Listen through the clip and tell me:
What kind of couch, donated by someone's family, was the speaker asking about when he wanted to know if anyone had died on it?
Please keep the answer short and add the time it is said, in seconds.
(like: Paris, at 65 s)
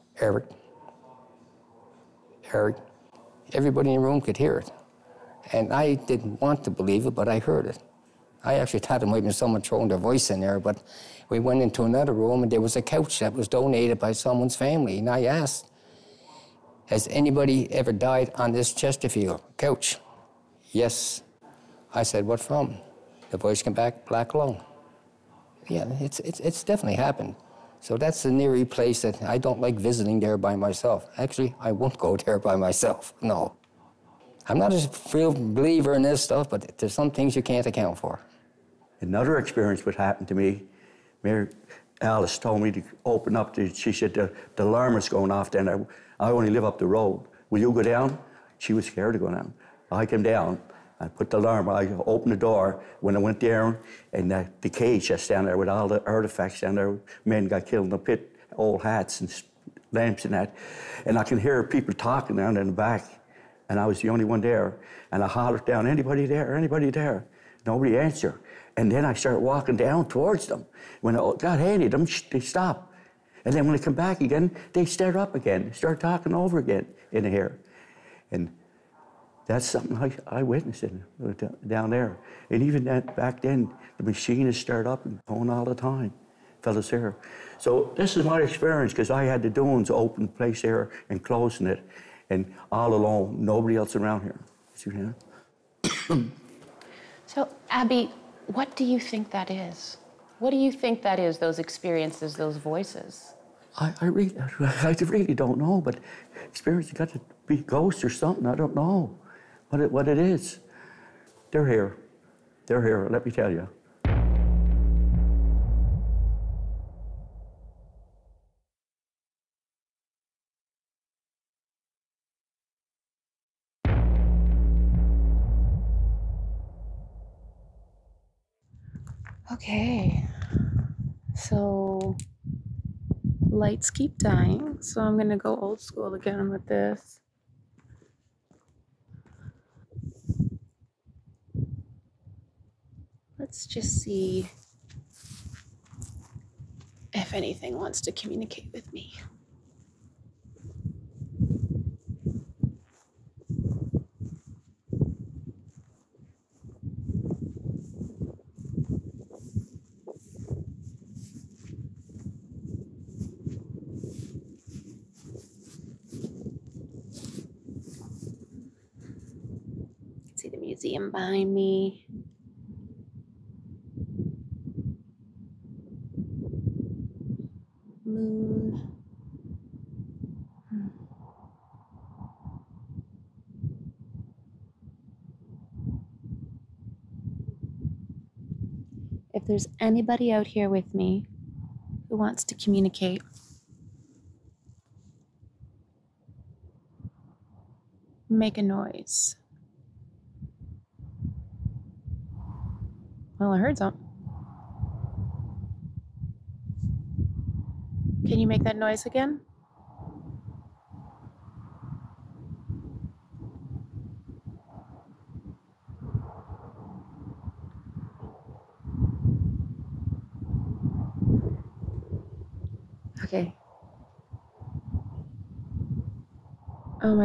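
Chesterfield, at 18 s.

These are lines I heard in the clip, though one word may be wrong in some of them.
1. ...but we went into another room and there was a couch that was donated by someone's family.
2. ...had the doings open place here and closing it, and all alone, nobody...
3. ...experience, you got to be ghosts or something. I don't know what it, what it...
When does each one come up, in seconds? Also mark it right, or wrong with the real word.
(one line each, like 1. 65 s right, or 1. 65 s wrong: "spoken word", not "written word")
1. 10 s right
2. 89 s right
3. 106 s right.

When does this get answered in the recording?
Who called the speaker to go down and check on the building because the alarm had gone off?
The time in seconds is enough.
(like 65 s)
41 s.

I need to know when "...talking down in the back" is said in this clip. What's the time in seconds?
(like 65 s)
61 s.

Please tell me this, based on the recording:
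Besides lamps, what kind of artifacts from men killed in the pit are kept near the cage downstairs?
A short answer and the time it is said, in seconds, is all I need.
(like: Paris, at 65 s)
old hats, at 58 s.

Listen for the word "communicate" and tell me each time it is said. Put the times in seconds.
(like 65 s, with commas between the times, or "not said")
148 s, 192 s.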